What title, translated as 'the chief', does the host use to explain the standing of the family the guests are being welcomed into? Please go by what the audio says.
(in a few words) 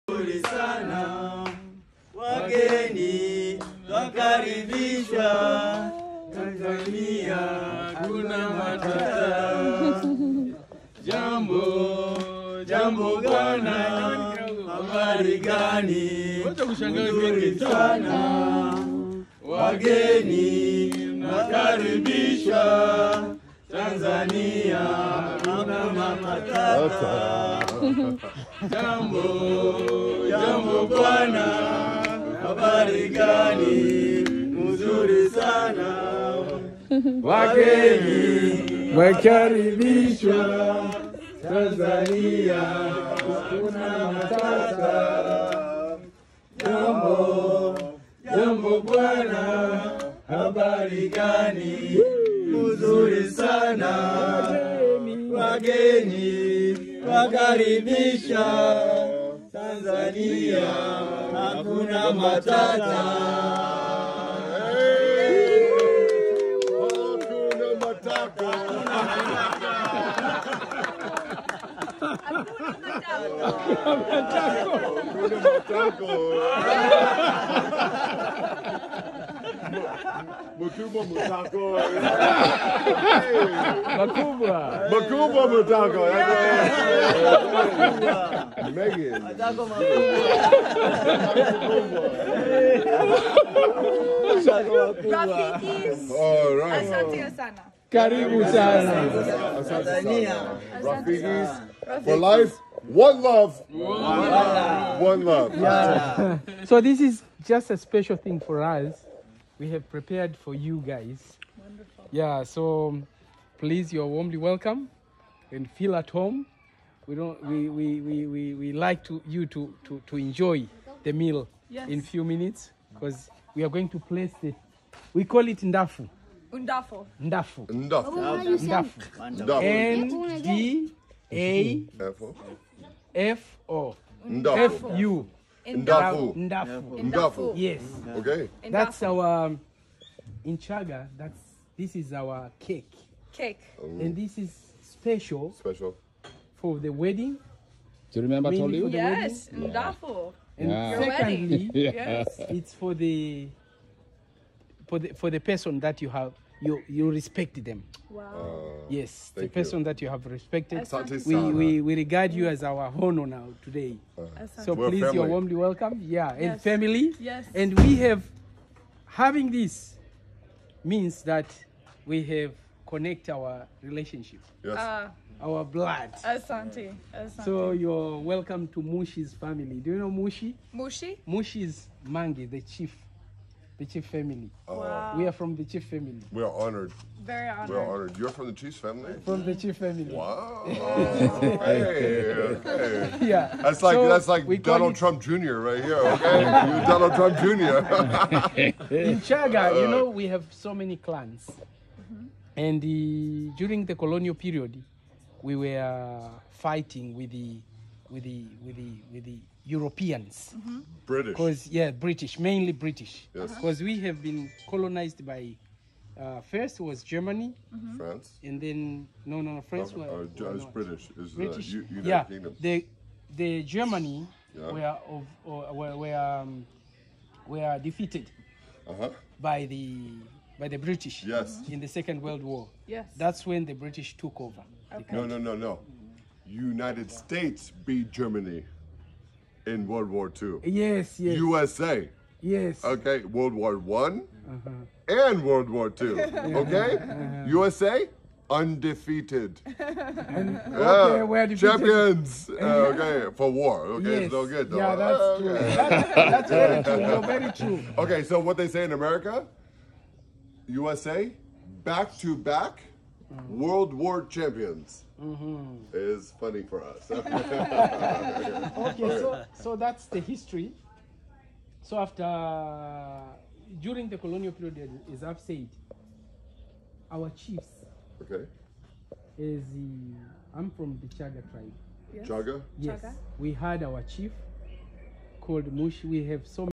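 Mangi.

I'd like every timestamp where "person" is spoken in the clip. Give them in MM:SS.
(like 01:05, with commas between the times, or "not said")
02:35, 02:39.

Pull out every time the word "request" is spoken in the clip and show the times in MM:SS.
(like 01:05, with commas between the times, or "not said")
not said.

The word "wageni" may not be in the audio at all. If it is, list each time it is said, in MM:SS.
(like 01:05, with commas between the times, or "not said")
00:19, 00:37, 00:55.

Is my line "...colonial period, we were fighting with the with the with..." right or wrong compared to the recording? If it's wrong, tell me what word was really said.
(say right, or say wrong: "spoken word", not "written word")
right.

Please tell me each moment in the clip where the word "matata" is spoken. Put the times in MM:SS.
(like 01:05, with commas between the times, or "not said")
00:08, 00:25, 00:44, 01:02.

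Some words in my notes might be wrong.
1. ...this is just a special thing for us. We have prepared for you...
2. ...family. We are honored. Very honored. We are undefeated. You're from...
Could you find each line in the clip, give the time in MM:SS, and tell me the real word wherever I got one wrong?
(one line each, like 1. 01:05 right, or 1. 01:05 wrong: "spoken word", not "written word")
1. 01:46 right
2. 03:05 wrong: "honored", not "undefeated".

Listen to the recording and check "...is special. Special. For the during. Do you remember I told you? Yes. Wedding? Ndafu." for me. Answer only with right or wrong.
wrong.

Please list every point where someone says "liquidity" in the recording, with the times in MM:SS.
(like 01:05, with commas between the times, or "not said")
not said.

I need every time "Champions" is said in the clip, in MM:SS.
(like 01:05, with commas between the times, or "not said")
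04:11, 04:24.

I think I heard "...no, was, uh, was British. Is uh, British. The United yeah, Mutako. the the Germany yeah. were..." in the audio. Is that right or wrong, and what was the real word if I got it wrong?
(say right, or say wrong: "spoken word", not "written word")
wrong: "Kingdom", not "Mutako".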